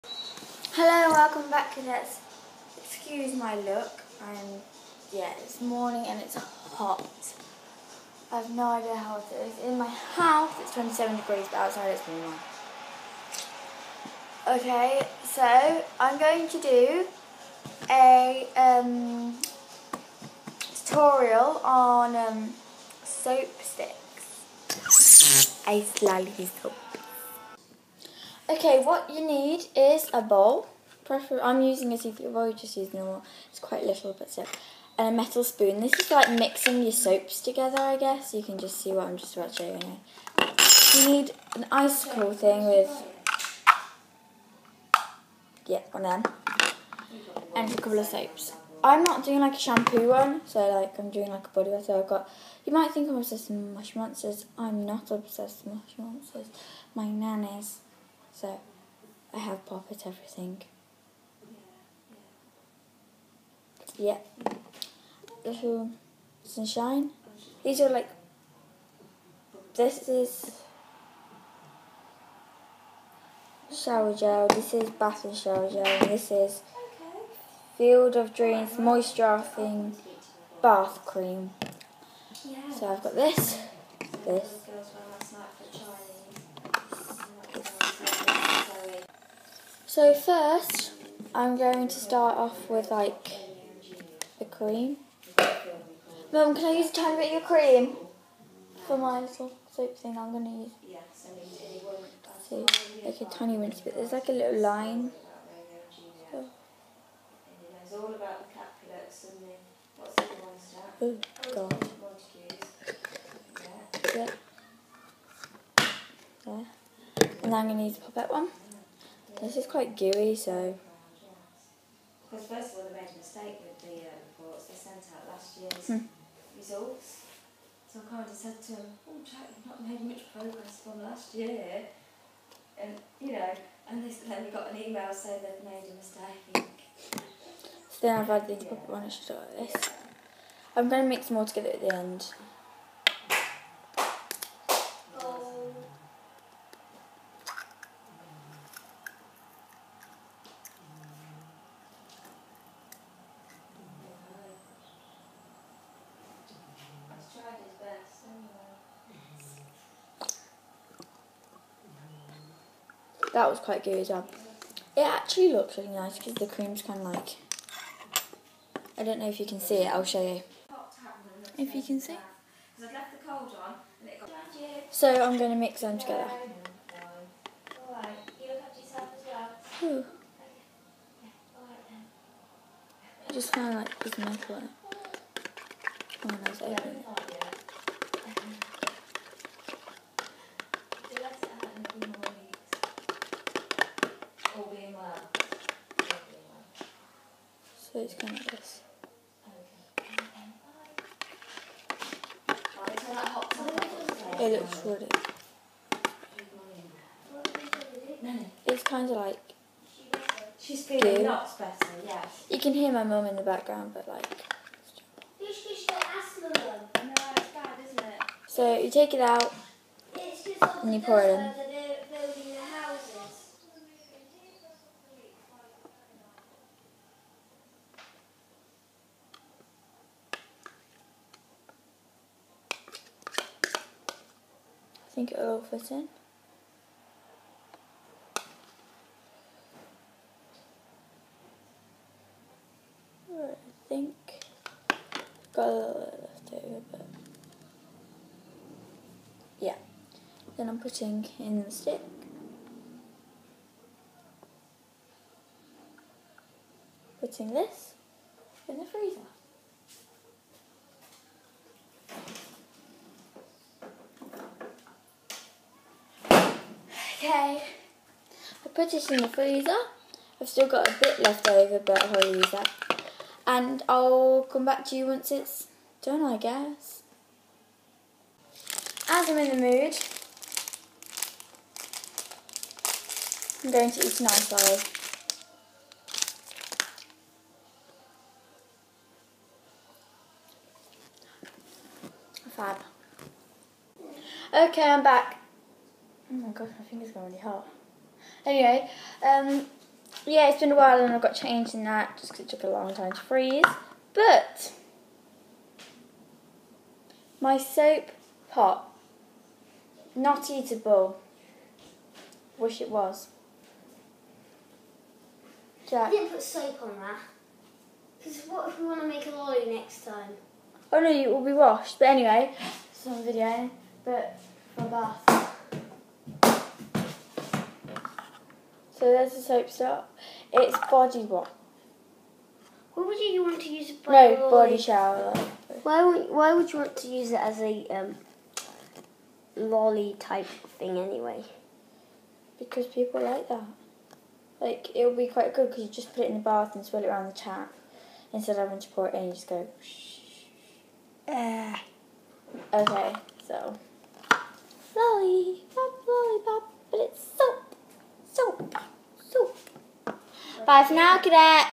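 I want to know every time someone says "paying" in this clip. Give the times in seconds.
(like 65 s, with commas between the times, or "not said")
not said.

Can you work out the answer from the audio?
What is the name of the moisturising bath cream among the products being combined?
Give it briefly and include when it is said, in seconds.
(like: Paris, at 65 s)
Field of Dreams, at 77 s.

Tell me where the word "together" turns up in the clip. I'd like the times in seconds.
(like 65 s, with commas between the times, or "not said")
37 s, 141 s, 175 s.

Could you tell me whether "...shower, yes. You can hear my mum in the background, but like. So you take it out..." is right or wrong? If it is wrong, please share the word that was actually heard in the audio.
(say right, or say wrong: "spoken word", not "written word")
wrong: "better", not "shower".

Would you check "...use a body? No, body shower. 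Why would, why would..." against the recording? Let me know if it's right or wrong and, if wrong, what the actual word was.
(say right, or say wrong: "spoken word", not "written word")
right.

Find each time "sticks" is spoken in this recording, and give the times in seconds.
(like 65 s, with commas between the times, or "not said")
23 s, 251 s.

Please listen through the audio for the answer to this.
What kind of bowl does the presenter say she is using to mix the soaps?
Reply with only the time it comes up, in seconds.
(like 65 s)
31 s.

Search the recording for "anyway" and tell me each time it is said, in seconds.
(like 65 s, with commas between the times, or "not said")
298 s, 322 s, 340 s.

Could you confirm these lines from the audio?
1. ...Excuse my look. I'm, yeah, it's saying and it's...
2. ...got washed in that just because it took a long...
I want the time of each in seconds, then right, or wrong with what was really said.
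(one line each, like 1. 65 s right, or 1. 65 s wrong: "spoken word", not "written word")
1. 2 s wrong: "morning", not "saying"
2. 301 s wrong: "changed", not "washed".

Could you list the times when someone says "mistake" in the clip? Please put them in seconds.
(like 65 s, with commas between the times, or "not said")
123 s, 135 s.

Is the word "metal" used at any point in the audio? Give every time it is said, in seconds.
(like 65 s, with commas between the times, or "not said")
35 s, 184 s.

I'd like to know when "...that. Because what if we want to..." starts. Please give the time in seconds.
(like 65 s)
317 s.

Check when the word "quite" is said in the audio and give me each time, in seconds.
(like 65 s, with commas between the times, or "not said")
33 s, 119 s, 163 s, 345 s.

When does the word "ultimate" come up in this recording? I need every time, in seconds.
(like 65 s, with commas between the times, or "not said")
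not said.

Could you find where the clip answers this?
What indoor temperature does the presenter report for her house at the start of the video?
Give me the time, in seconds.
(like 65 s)
10 s.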